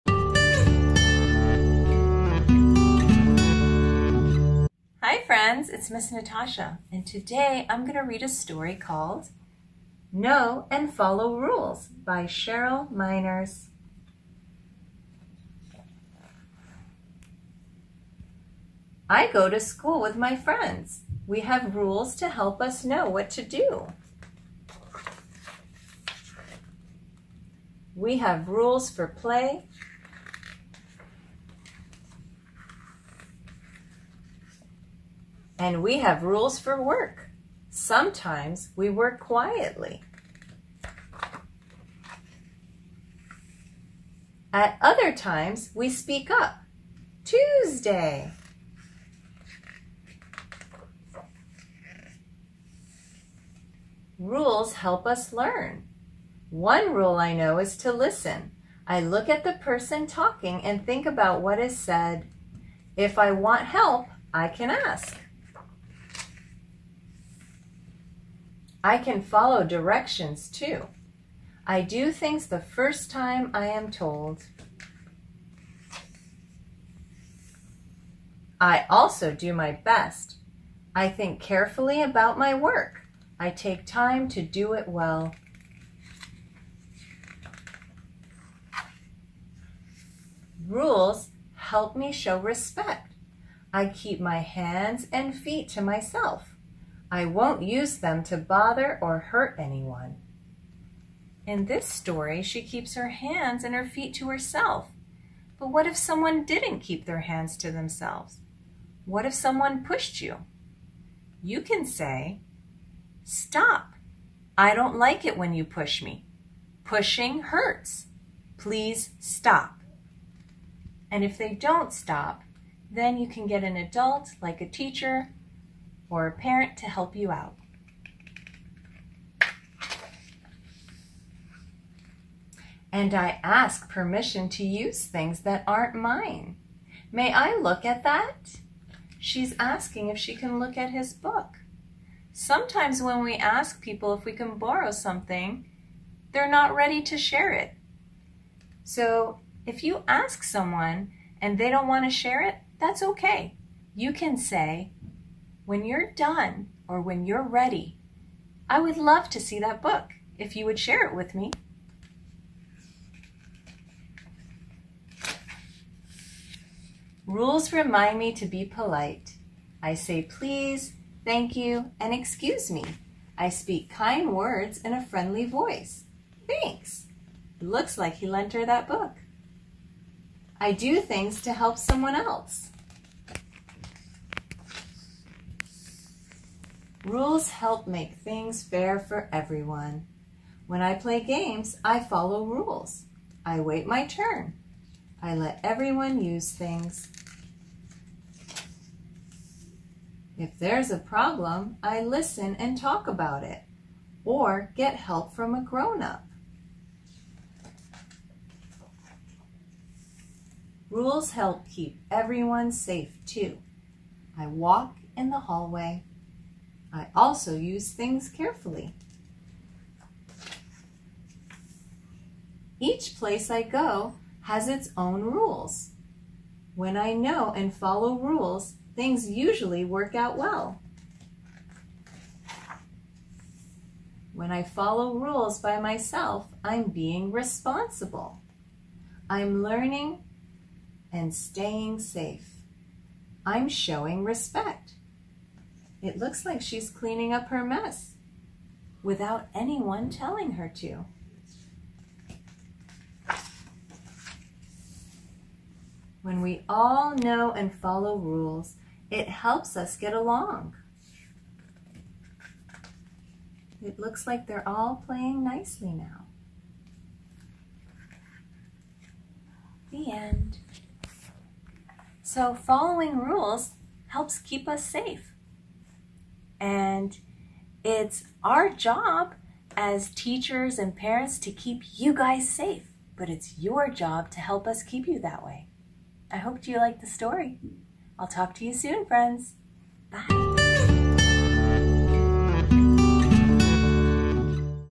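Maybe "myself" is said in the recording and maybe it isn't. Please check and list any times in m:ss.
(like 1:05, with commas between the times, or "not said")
1:35, 3:55.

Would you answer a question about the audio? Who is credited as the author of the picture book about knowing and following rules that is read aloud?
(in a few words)
Cheryl Meiners.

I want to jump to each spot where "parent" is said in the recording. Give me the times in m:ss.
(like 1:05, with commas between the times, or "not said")
2:06, 4:40.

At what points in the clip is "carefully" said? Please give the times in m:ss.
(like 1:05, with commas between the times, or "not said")
1:21, 3:38.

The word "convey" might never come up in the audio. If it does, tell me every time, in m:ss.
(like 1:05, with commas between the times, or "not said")
not said.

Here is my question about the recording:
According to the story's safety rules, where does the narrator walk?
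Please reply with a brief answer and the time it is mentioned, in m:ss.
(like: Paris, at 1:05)
in the hallway, at 3:35.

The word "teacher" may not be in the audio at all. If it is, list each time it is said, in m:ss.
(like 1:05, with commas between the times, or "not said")
2:04, 4:40.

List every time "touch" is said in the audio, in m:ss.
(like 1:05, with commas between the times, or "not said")
not said.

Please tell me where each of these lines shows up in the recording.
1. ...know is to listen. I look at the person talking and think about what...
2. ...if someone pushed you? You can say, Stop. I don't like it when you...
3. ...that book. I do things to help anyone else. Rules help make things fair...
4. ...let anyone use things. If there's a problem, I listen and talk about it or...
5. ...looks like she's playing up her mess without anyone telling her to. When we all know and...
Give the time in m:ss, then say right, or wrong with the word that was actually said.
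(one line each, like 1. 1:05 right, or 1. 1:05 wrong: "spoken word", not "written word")
1. 0:57 right
2. 1:49 right
3. 2:58 wrong: "someone", not "anyone"
4. 3:15 wrong: "everyone", not "anyone"
5. 4:06 wrong: "cleaning", not "playing".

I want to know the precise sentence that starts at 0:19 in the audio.
I go to school with my friends.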